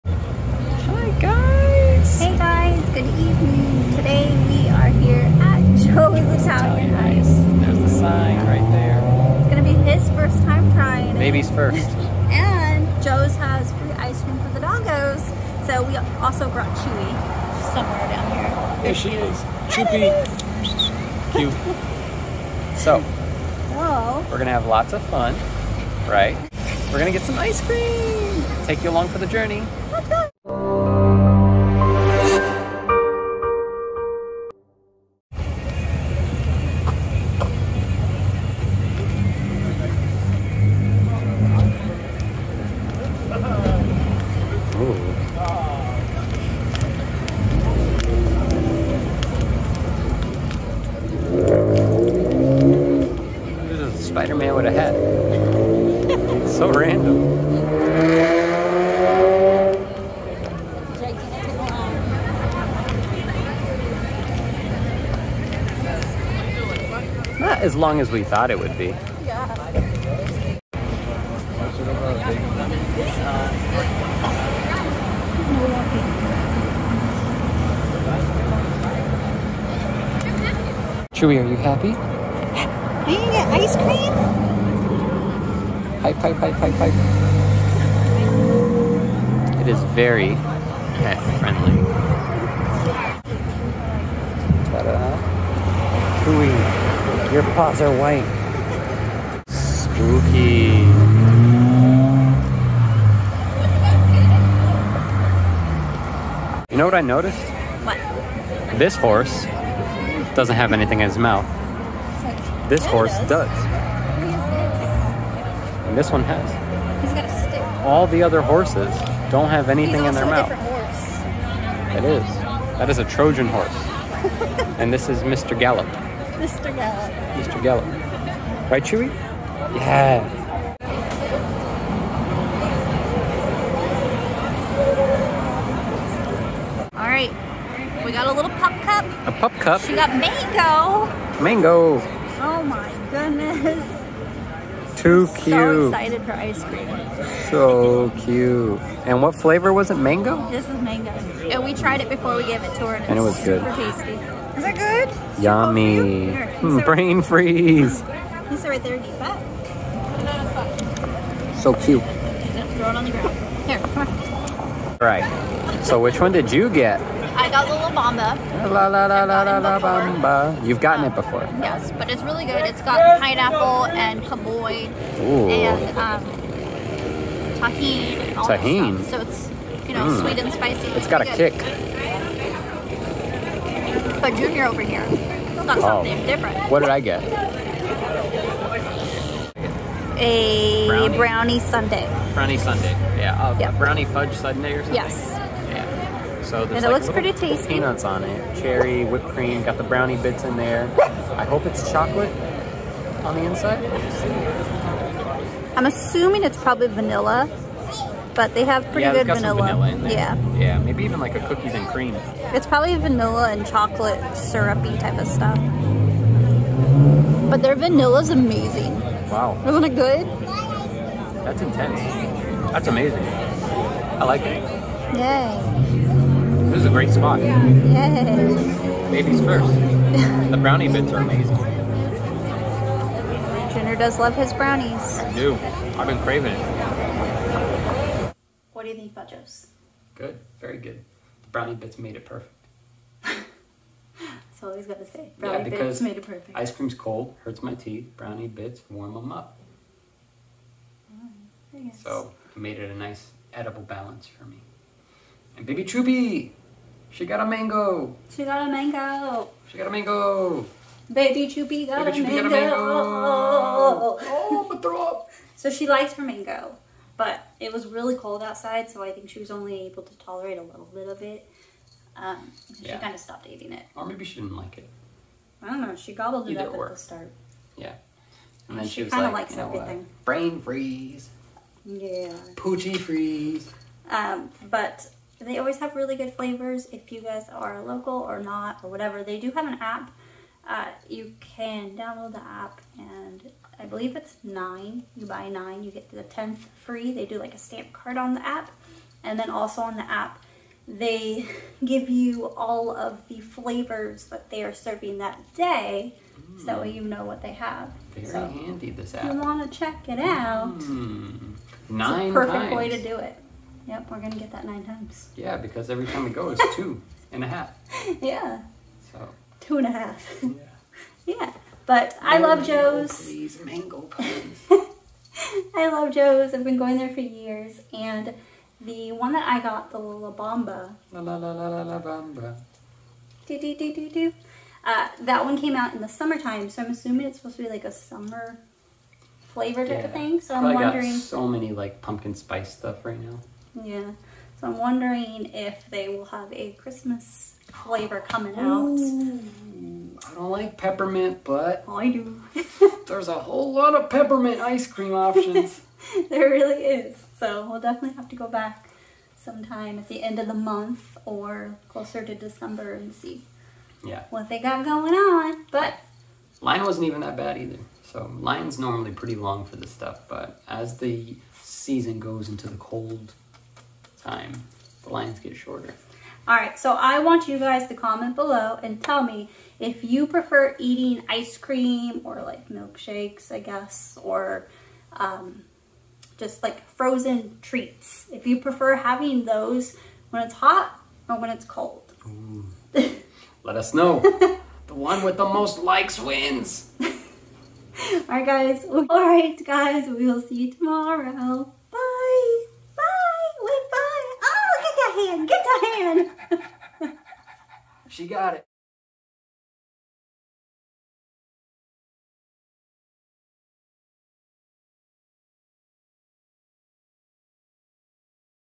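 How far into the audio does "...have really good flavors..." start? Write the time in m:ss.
4:45.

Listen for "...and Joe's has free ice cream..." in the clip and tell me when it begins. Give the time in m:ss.
0:12.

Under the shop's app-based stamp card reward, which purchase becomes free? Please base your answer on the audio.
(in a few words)
The 10th.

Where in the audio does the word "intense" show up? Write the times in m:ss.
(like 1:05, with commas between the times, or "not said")
3:41.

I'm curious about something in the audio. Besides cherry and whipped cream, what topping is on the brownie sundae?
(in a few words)
Peanuts.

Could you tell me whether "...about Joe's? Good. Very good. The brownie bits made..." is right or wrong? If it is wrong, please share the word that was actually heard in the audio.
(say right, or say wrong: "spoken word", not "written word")
right.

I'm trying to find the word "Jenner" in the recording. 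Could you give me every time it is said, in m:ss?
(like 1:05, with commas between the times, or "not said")
3:53.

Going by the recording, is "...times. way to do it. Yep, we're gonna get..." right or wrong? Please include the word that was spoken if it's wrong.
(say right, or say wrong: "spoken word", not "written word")
right.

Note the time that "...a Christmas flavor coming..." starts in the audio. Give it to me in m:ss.
5:46.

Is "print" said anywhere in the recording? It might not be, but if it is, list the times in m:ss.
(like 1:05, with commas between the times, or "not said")
not said.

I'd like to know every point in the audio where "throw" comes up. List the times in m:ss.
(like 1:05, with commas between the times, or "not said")
2:42, 4:24.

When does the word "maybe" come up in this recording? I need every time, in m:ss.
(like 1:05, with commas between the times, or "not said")
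3:30, 4:34.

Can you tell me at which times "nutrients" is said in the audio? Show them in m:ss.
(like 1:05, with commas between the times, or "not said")
not said.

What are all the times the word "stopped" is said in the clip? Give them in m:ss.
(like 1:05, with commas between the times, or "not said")
4:33.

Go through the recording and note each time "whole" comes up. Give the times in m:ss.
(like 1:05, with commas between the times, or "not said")
5:53.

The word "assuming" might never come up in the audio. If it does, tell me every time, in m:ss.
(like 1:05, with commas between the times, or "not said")
3:25, 5:36.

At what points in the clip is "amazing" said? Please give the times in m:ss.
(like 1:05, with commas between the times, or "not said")
3:38, 3:42, 3:51.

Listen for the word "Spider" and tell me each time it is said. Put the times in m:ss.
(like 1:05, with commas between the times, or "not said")
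0:54.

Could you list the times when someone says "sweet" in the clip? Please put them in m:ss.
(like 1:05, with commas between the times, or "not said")
3:00.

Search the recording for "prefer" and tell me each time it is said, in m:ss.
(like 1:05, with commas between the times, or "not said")
6:20, 6:28.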